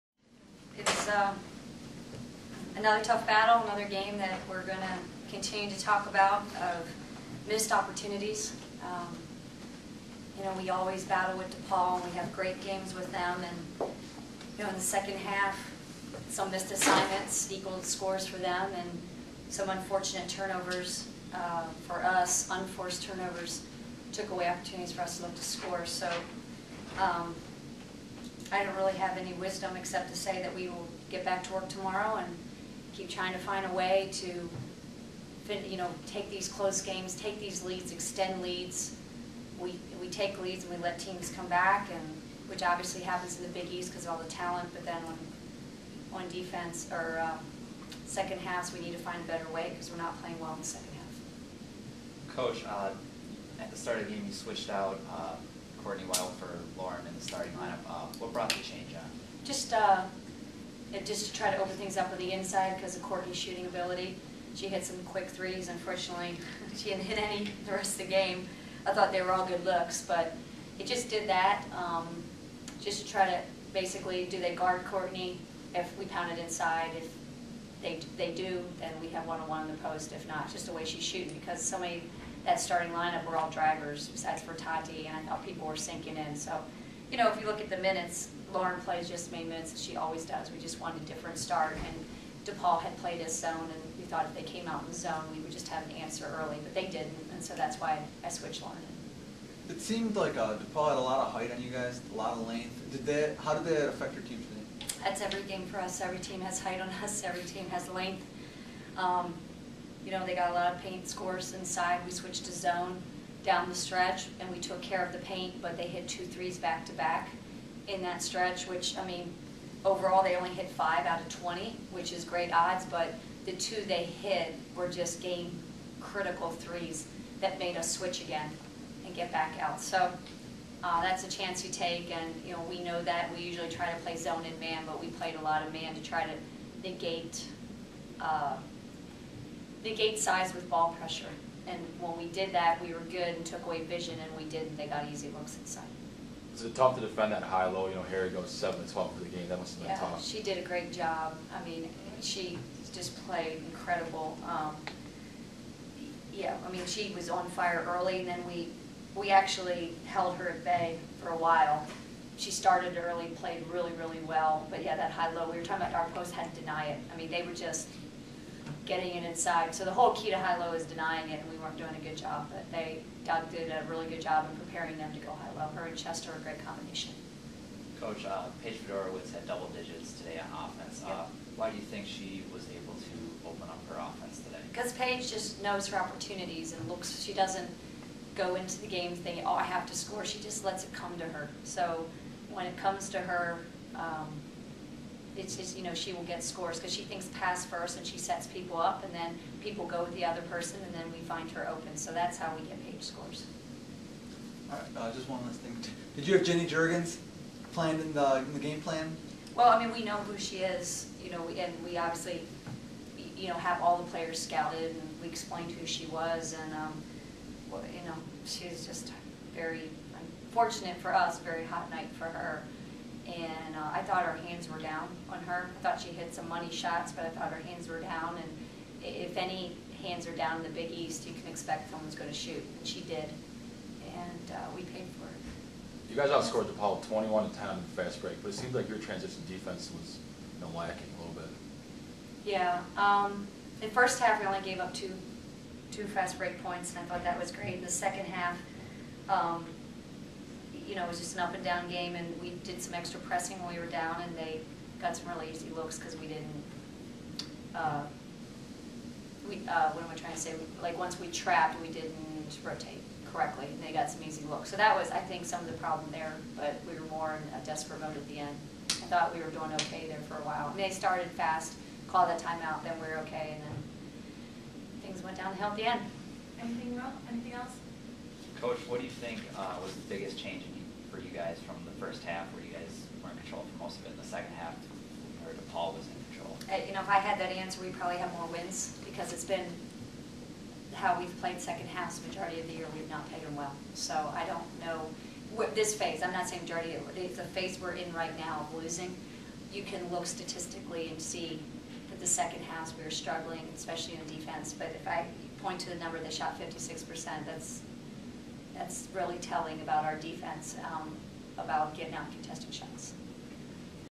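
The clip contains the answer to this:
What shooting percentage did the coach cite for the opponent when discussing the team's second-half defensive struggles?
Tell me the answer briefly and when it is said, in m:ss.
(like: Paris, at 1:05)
56%, at 5:06.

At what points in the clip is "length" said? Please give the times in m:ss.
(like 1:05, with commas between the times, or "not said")
1:42, 1:47.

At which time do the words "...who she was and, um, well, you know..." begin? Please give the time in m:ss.
3:35.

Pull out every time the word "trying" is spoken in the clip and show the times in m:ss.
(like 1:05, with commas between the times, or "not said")
0:33, 4:20.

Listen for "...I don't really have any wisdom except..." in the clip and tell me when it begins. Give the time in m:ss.
0:28.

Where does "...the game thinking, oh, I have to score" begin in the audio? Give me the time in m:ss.
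3:08.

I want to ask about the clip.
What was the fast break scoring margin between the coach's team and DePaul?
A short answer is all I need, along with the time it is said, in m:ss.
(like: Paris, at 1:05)
21 to 10, at 3:57.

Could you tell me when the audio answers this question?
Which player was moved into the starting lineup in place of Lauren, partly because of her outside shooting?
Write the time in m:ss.
0:55.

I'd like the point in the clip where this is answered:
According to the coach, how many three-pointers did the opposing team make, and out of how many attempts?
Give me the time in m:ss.
2:00.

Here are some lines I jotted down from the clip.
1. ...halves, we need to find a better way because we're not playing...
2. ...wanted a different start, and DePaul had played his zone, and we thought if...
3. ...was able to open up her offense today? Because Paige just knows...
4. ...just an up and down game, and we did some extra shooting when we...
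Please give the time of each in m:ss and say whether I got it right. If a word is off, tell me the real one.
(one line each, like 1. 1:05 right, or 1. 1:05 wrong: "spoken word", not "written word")
1. 0:48 right
2. 1:30 right
3. 3:02 right
4. 4:11 wrong: "pressing", not "shooting".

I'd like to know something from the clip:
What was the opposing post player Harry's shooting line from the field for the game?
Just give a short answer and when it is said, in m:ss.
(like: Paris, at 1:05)
7 to 12, at 2:28.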